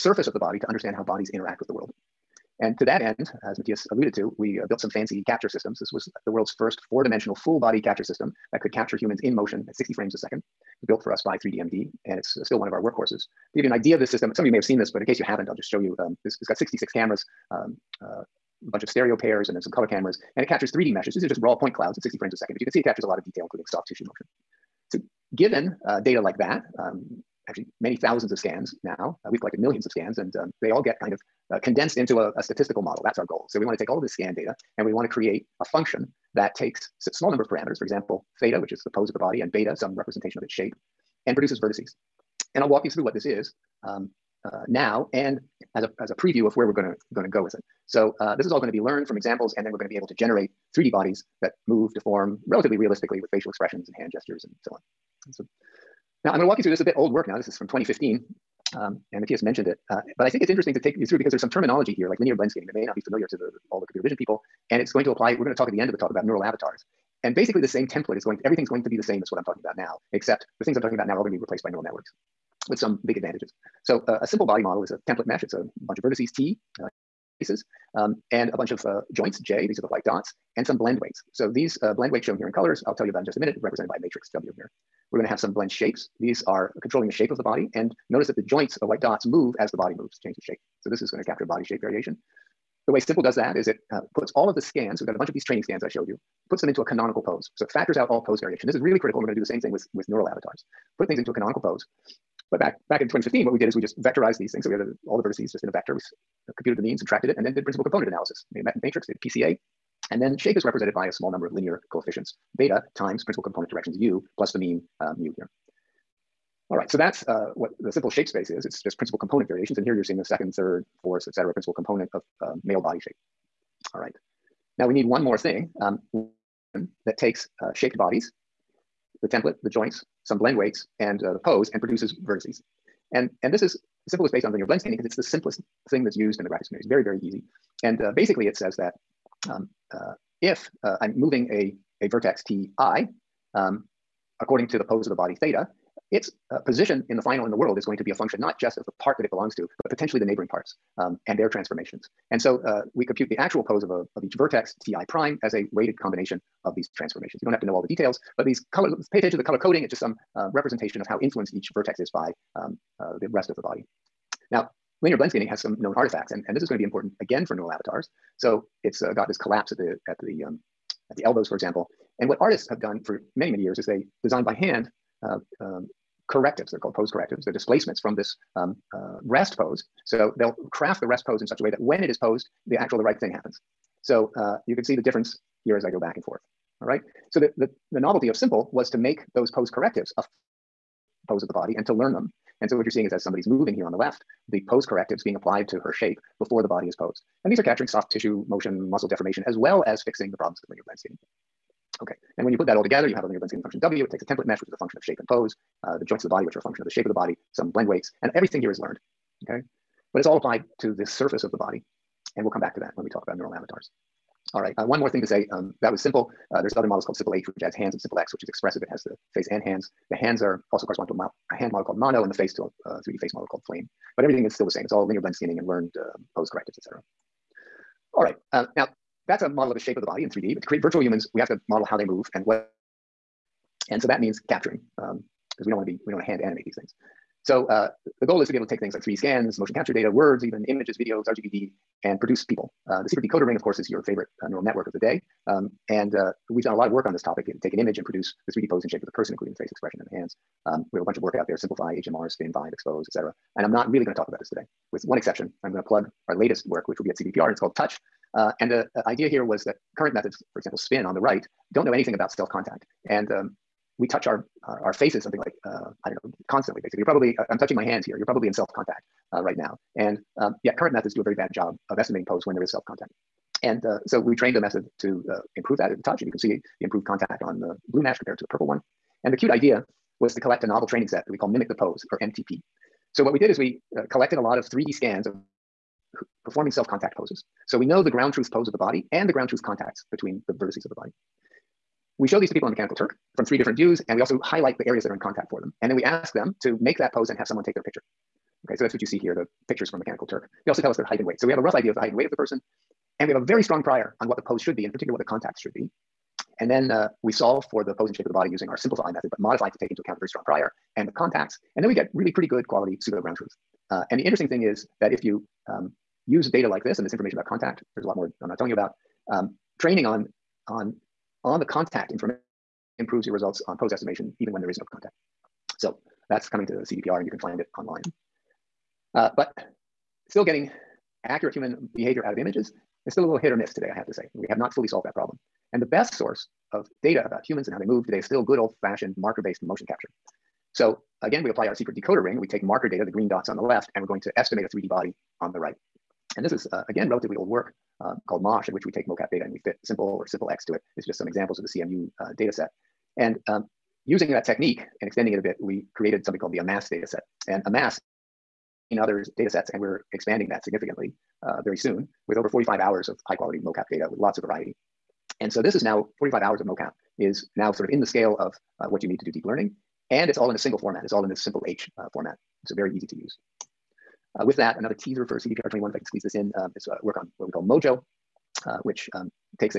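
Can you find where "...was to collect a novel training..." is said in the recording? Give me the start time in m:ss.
4:40.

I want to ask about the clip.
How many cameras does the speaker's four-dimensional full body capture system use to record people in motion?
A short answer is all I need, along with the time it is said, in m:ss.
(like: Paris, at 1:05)
66, at 0:16.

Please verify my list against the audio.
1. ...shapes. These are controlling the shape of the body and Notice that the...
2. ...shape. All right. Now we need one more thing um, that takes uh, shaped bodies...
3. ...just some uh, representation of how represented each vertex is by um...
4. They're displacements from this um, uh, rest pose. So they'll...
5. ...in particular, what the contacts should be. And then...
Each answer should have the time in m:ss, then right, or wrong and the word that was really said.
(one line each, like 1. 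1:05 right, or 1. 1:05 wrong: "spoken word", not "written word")
1. 1:25 right
2. 2:03 right
3. 2:39 wrong: "influenced", not "represented"
4. 2:57 right
5. 5:04 right.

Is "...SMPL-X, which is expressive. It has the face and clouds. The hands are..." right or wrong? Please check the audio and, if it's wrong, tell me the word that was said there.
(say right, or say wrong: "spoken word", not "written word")
wrong: "hands", not "clouds".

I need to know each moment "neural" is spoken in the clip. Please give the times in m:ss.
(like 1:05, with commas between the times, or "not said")
1:06, 1:11, 1:40, 2:47, 3:33, 4:04.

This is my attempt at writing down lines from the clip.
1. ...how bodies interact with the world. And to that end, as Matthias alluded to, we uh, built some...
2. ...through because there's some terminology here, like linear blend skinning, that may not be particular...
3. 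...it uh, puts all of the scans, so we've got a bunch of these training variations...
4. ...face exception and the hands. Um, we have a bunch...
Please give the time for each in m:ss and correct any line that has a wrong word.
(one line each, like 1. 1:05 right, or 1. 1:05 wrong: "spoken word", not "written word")
1. 0:00 right
2. 1:01 wrong: "familiar", not "particular"
3. 1:33 wrong: "scans", not "variations"
4. 4:09 wrong: "expression", not "exception".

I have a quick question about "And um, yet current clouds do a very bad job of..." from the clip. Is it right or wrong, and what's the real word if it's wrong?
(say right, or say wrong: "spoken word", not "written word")
wrong: "methods", not "clouds".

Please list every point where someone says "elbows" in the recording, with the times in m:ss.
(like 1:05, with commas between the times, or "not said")
2:51.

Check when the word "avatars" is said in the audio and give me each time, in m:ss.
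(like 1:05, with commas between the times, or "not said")
1:06, 1:40, 2:47, 3:33.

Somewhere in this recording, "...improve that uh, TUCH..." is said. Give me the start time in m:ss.
4:35.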